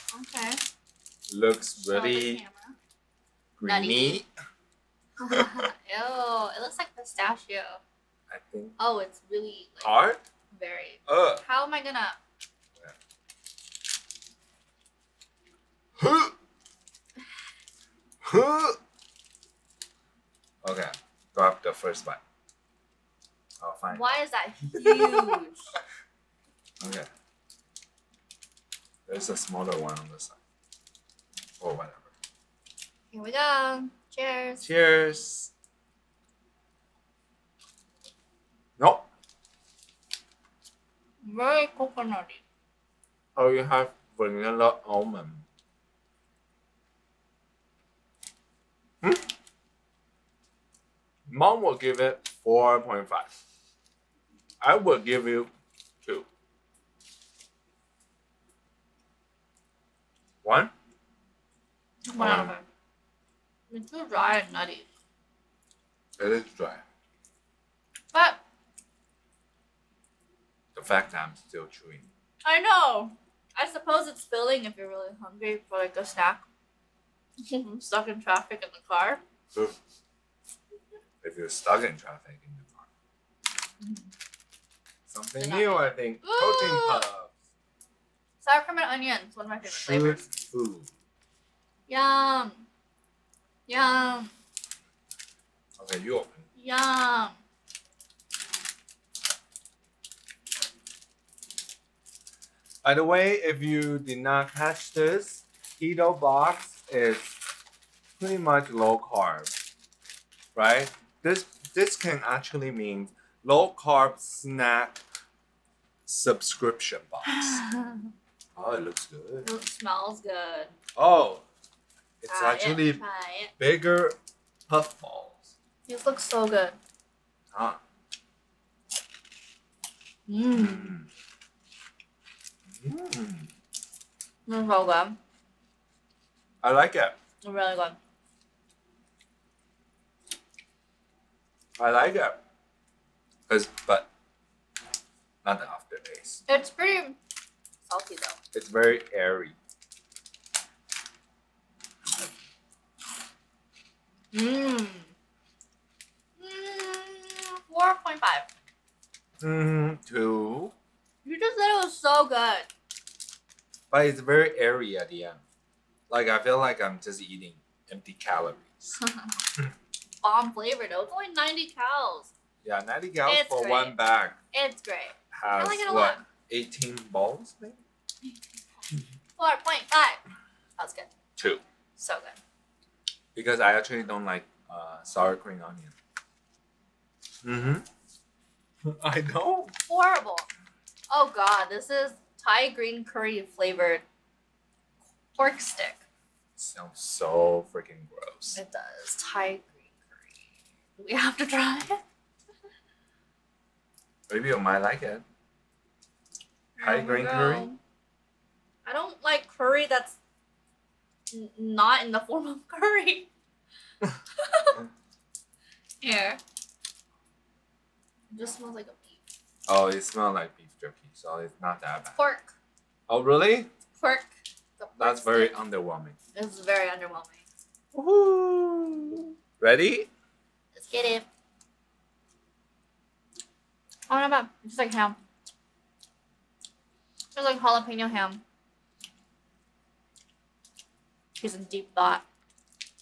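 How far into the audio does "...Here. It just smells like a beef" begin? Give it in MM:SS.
03:35.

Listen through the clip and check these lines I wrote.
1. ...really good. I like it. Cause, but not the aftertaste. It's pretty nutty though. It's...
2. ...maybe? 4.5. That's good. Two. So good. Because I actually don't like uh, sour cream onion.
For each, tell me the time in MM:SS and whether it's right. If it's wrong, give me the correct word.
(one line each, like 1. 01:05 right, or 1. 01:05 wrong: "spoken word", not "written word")
1. 02:17 wrong: "salty", not "nutty"
2. 02:57 right.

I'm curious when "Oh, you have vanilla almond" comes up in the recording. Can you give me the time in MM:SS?
00:43.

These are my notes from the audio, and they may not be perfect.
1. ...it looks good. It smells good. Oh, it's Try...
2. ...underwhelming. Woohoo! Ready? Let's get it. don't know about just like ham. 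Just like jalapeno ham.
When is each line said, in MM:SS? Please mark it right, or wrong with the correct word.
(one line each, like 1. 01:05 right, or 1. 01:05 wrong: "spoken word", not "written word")
1. 01:58 right
2. 03:46 right.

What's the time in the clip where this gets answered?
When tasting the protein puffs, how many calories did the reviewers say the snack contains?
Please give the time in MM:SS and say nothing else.
02:51.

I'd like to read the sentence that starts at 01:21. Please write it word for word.
If you're stuck in traffic in the car.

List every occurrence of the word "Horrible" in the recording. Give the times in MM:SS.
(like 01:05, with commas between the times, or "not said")
03:09.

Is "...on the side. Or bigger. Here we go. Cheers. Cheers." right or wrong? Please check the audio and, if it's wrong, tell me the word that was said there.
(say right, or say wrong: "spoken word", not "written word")
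wrong: "whatever", not "bigger".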